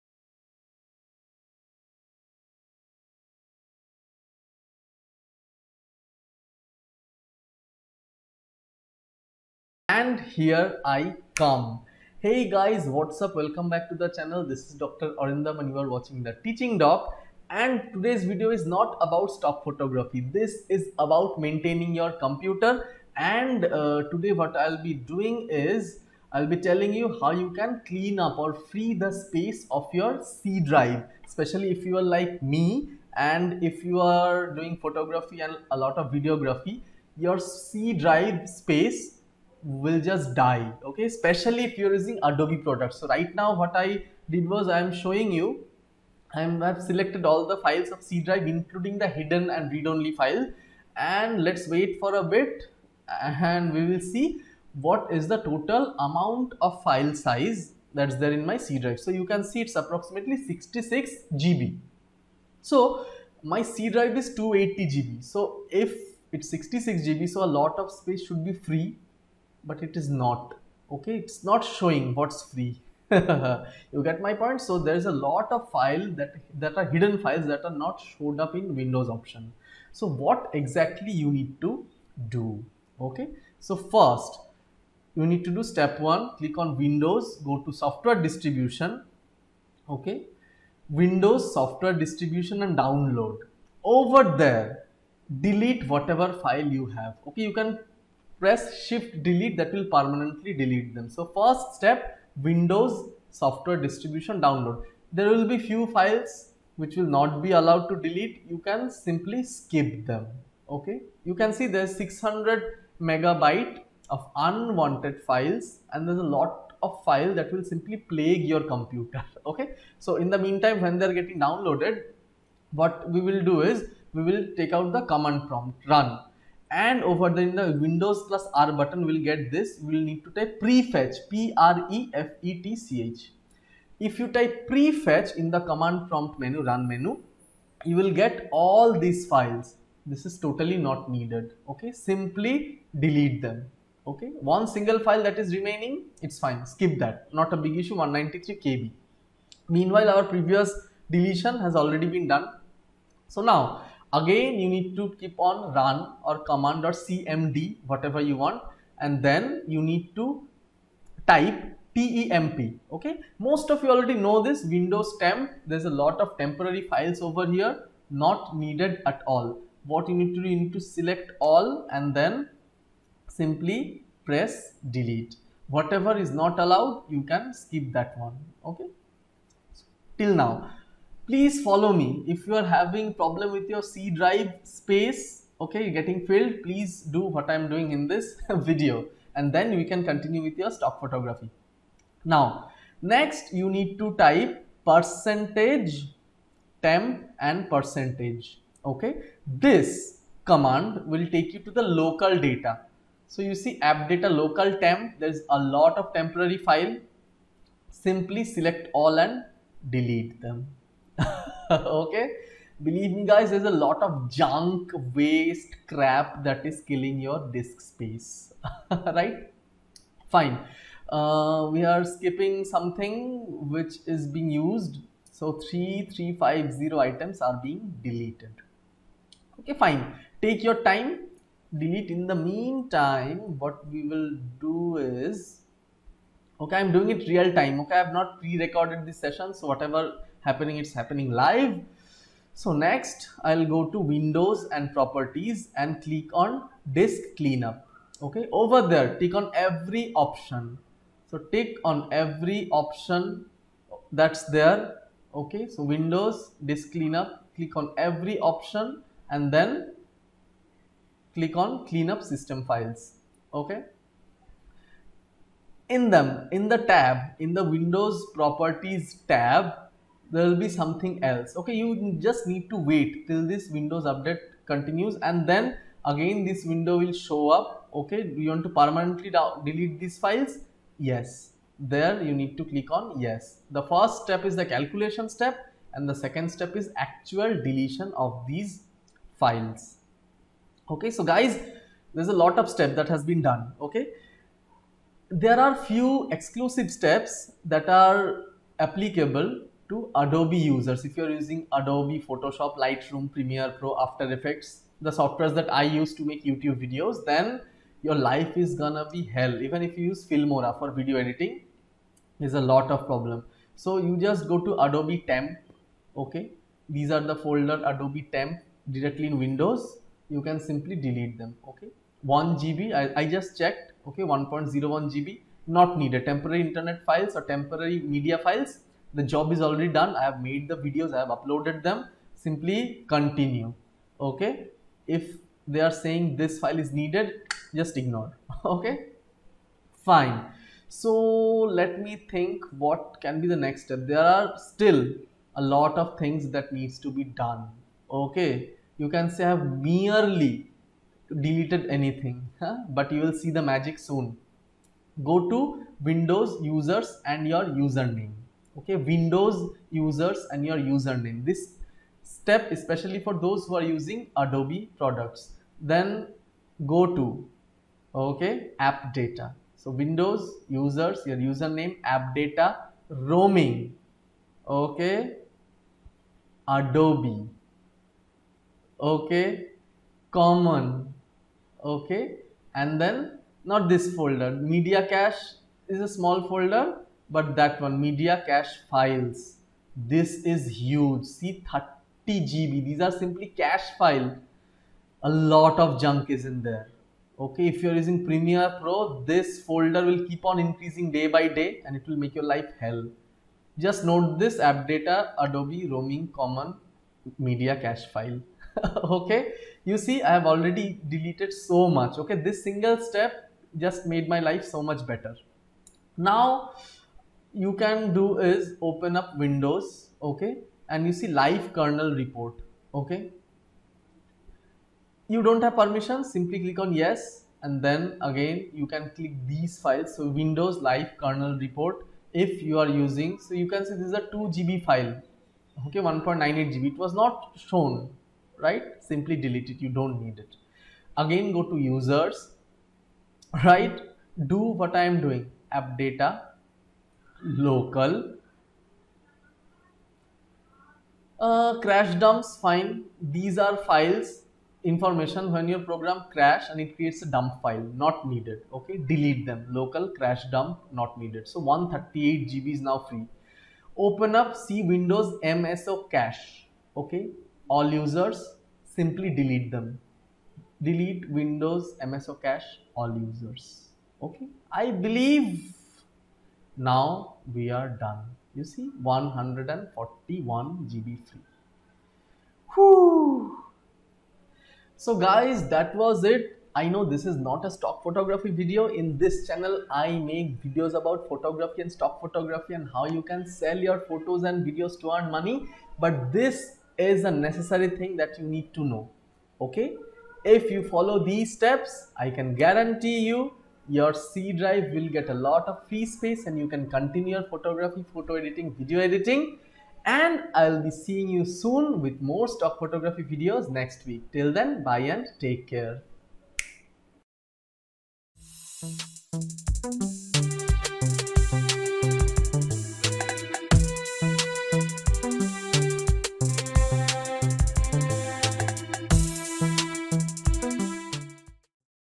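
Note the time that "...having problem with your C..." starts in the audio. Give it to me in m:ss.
3:02.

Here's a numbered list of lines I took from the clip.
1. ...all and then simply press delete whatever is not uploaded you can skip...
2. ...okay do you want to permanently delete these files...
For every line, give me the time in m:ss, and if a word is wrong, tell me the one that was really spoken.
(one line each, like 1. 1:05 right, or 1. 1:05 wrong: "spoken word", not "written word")
1. 2:51 wrong: "allowed", not "uploaded"
2. 4:37 right.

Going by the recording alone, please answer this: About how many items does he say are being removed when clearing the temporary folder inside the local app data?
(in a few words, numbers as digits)
3350.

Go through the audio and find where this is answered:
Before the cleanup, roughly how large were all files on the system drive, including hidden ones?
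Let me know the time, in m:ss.
0:59.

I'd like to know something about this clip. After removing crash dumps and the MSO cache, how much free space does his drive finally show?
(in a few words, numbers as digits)
141 GB.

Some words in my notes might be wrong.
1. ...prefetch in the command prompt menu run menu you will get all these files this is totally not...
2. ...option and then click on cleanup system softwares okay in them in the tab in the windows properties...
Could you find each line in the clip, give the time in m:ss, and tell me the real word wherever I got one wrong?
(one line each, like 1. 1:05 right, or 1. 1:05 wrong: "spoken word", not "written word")
1. 2:14 right
2. 4:18 wrong: "files", not "softwares".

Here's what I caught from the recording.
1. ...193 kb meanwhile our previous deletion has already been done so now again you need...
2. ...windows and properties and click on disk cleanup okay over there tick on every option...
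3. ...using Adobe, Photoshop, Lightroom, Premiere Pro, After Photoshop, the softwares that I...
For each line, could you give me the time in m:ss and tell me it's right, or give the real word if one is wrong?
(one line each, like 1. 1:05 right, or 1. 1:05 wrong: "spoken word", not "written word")
1. 2:28 right
2. 4:03 right
3. 5:01 wrong: "Effects", not "Photoshop".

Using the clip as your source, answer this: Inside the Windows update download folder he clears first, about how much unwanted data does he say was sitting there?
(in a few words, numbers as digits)
600 megabytes.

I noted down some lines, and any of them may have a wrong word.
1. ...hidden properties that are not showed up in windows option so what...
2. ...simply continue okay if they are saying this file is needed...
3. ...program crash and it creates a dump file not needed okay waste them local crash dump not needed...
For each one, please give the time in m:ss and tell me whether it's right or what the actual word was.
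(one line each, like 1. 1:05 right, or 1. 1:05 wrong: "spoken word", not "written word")
1. 1:16 wrong: "files", not "properties"
2. 5:32 right
3. 7:35 wrong: "delete", not "waste".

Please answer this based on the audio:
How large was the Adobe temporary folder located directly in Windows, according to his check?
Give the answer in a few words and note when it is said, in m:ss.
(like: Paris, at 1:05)
1.01 GB, at 5:24.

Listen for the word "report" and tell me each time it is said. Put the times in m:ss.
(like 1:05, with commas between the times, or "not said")
7:02, 7:11.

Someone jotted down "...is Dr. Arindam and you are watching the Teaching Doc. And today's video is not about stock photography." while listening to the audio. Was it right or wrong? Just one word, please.
right.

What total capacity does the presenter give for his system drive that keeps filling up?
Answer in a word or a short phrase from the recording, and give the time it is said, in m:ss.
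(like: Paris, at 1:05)
280 GB, at 1:04.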